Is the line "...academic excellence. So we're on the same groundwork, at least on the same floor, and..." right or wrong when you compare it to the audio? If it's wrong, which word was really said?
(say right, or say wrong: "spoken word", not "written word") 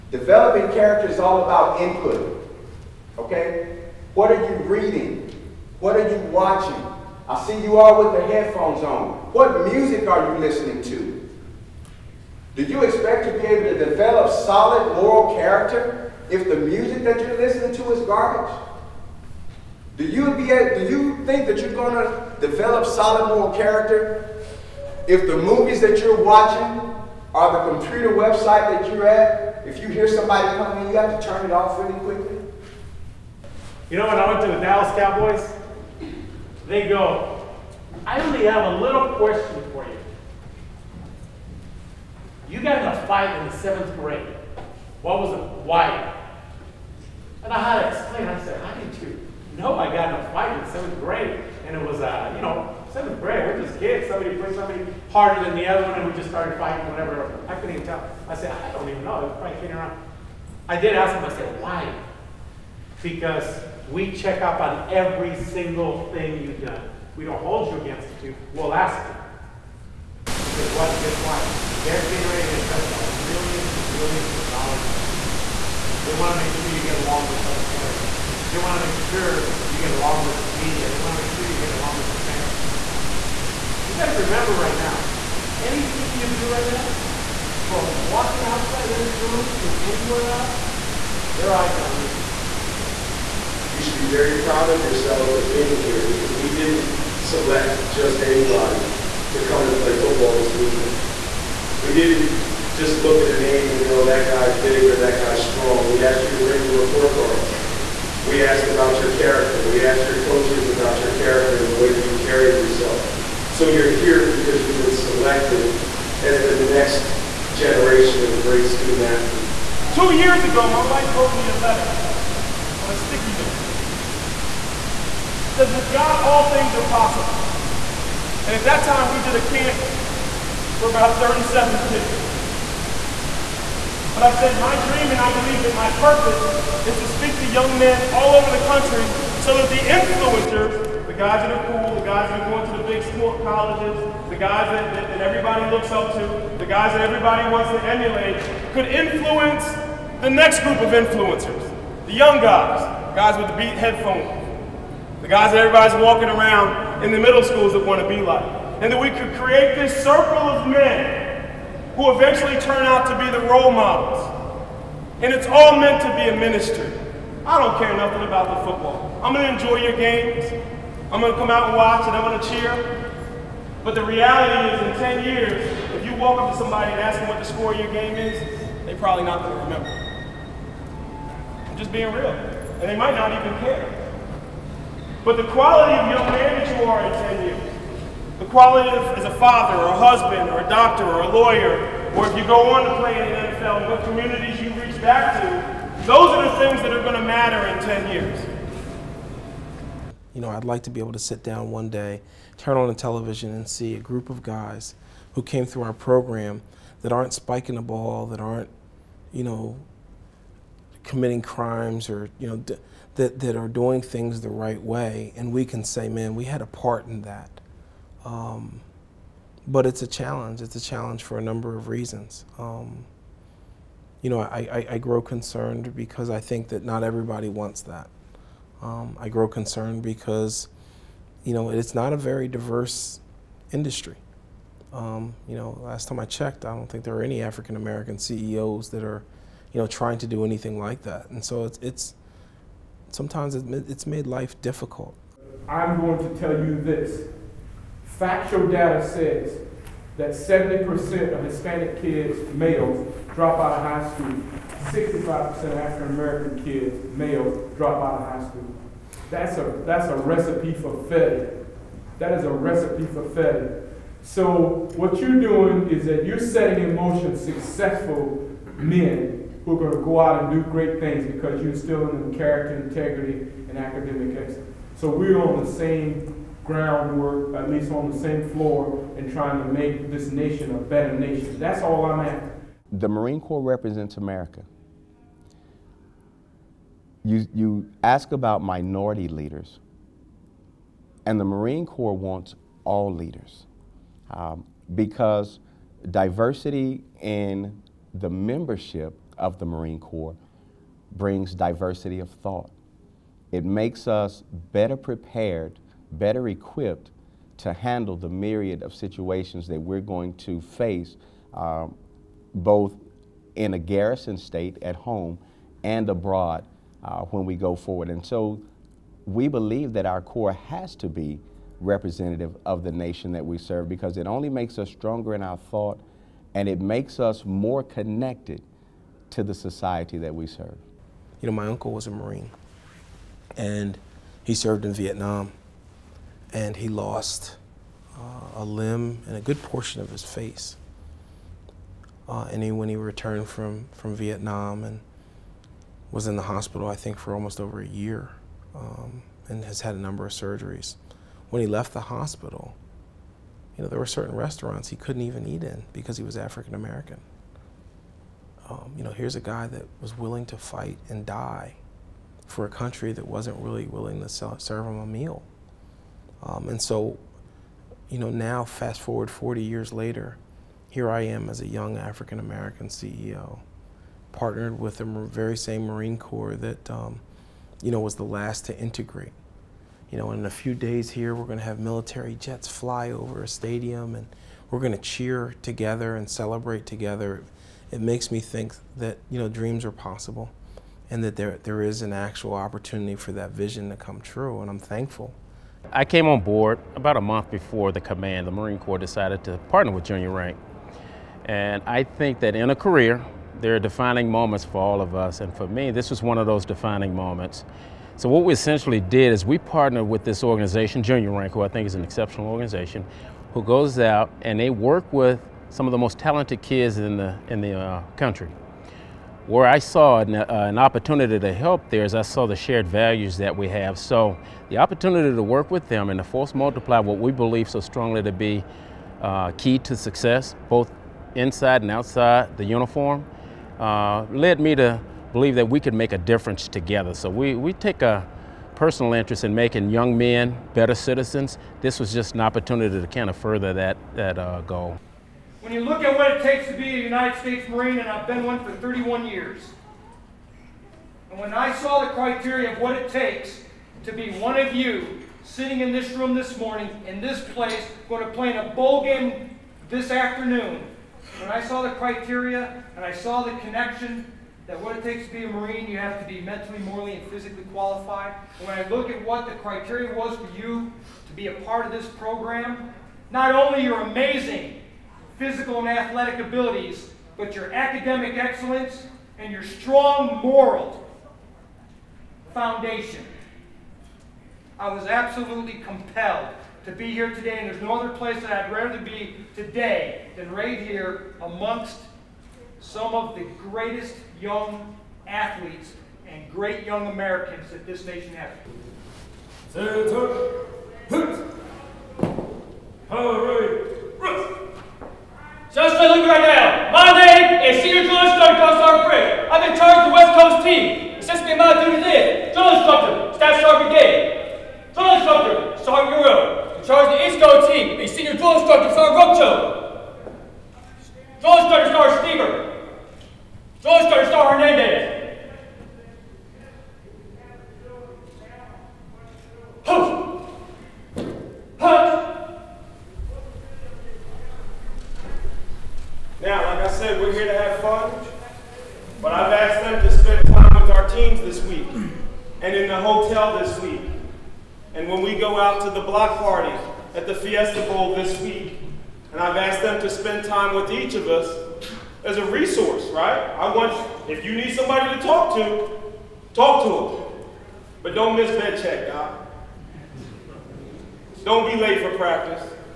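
right.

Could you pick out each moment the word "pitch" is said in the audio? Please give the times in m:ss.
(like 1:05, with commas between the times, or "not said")
not said.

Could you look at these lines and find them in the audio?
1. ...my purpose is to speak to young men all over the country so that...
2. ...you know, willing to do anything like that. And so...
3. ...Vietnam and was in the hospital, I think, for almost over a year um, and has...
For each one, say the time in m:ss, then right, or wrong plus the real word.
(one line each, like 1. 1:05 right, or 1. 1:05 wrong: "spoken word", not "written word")
1. 2:15 right
2. 3:59 wrong: "trying", not "willing"
3. 5:44 right.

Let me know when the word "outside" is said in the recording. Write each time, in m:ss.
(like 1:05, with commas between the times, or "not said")
1:28, 7:11.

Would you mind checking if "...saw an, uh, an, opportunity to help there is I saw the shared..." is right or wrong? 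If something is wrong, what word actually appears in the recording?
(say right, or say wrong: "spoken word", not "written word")
right.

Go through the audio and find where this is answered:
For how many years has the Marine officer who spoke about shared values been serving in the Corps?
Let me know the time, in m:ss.
7:28.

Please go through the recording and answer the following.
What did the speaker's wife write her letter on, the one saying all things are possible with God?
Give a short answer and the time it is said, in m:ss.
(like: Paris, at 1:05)
A sticky note, at 2:02.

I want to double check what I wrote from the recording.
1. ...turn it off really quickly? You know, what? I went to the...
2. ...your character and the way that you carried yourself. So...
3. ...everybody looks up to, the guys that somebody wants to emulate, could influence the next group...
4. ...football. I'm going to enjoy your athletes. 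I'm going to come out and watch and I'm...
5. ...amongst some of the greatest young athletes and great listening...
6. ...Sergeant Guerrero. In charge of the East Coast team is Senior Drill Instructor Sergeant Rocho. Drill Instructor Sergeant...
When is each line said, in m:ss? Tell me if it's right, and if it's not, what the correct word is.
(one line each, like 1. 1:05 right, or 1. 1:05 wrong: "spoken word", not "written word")
1. 0:31 right
2. 1:51 right
3. 2:25 wrong: "everybody", not "somebody"
4. 2:48 wrong: "games", not "athletes"
5. 8:11 wrong: "young", not "listening"
6. 8:35 right.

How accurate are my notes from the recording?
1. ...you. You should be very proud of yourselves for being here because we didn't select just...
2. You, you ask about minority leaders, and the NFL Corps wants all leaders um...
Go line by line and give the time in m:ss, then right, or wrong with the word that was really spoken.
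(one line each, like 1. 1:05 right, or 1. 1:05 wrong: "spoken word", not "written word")
1. 1:32 right
2. 4:47 wrong: "Marine", not "NFL".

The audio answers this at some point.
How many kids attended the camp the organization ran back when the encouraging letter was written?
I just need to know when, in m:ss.
2:11.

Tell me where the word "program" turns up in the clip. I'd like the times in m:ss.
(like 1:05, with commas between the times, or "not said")
3:25, 7:52.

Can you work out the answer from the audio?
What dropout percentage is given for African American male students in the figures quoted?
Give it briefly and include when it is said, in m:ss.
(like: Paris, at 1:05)
65%, at 4:14.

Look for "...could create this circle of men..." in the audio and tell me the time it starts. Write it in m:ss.
2:39.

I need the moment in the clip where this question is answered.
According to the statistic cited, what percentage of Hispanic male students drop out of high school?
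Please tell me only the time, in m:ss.
4:10.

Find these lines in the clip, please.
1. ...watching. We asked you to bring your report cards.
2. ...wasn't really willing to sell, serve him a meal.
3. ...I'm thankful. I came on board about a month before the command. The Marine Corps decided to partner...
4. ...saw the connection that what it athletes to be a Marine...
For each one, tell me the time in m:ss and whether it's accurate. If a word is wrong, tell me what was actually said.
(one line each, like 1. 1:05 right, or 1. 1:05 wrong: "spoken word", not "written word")
1. 1:45 wrong: "strong", not "watching"
2. 6:03 right
3. 6:34 right
4. 7:43 wrong: "takes", not "athletes".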